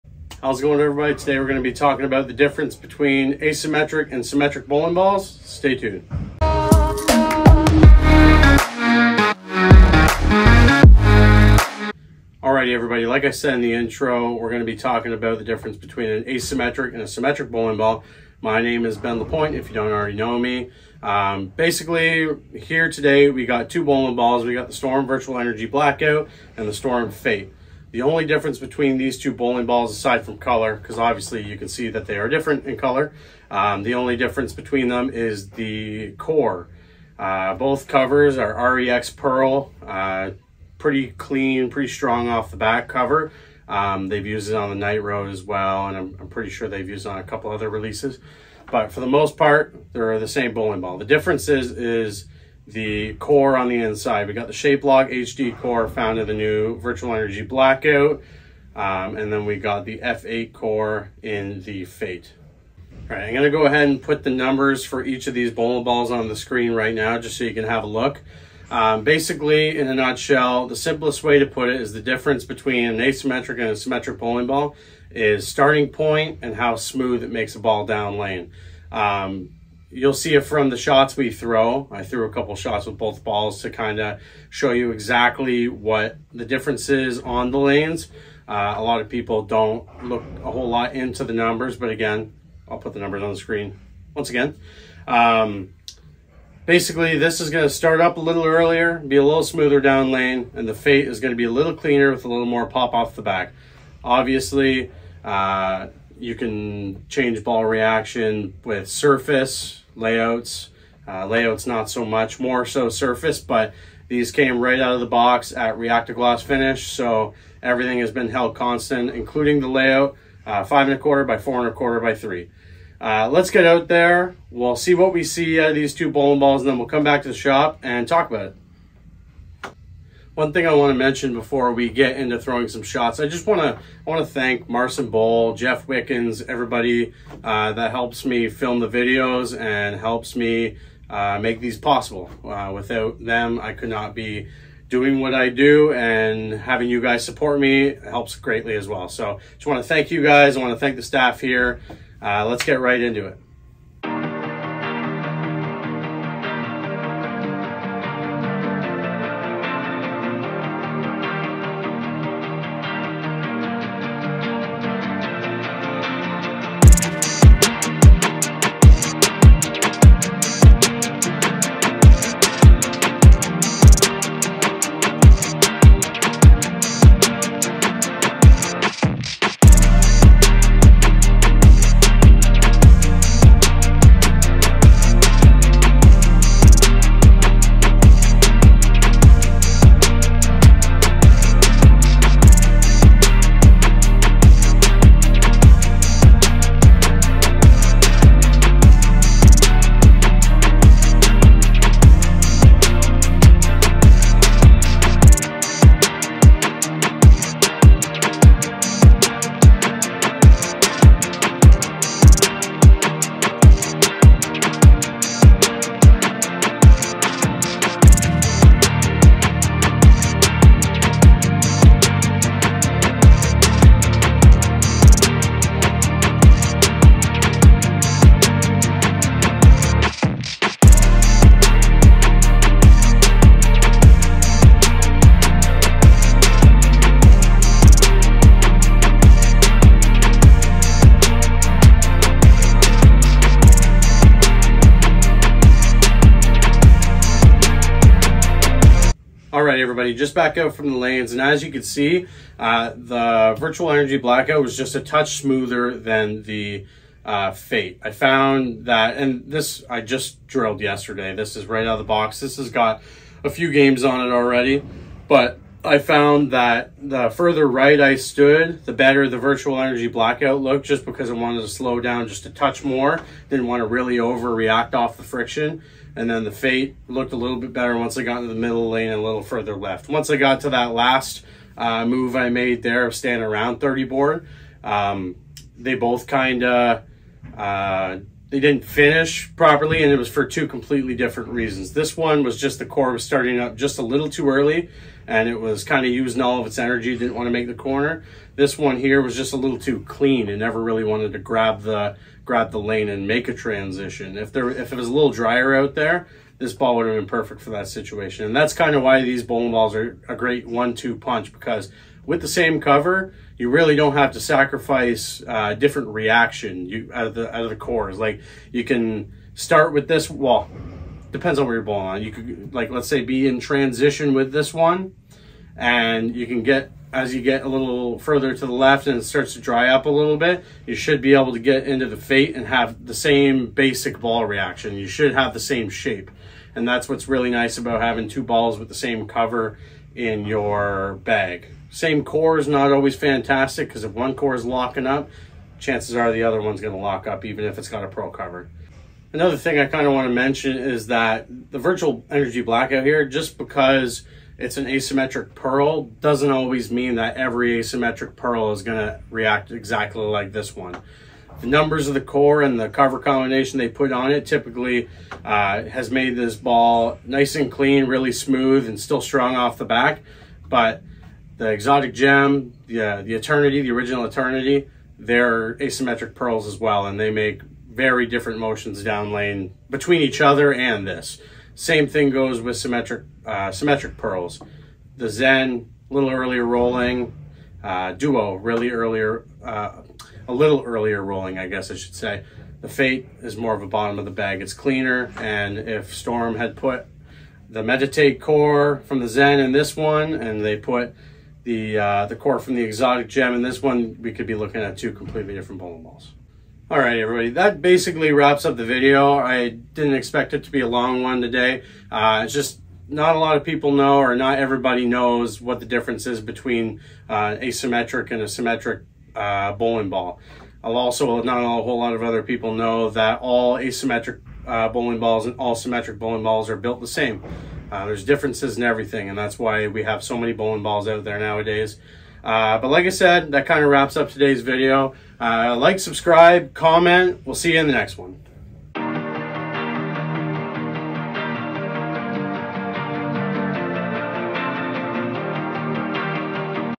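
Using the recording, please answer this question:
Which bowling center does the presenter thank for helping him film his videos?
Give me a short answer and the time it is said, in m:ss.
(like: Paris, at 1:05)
Marson Bowl, at 2:14.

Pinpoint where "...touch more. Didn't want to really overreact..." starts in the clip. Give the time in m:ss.
4:32.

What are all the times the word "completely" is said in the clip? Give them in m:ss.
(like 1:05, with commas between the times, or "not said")
4:50, 6:45.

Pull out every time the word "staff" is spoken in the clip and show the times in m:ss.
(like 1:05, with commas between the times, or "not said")
2:31.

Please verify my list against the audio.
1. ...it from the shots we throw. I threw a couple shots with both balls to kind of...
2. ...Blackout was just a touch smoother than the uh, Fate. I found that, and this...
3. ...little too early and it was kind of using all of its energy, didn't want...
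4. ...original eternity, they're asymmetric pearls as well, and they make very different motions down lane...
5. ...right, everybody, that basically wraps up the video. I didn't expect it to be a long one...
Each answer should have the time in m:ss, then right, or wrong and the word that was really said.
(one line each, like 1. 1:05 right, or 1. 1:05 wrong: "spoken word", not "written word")
1. 1:20 right
2. 4:14 right
3. 4:54 right
4. 6:13 right
5. 6:46 right.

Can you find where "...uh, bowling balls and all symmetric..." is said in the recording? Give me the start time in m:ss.
7:04.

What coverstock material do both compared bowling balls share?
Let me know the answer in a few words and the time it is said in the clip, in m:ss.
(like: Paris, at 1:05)
ReX Pearl, at 0:38.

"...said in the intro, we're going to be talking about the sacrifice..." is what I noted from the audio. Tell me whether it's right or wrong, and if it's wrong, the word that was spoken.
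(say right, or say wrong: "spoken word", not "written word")
wrong: "difference", not "sacrifice".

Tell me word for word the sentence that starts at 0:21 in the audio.
Um, basically, here today we got two bowling balls.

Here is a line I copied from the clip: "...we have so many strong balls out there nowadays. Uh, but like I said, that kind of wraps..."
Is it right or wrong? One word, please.
wrong.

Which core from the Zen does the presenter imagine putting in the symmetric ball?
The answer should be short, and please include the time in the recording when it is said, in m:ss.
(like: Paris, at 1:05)
Meditate, at 6:37.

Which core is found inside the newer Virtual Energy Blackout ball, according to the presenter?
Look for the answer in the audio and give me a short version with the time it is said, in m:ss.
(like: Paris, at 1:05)
ShapeLog HD, at 0:54.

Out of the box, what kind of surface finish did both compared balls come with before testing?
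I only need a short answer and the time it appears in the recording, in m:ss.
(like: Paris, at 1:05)
Reacta Gloss, at 1:55.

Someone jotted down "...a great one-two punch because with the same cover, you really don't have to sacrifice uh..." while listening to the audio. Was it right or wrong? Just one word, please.
right.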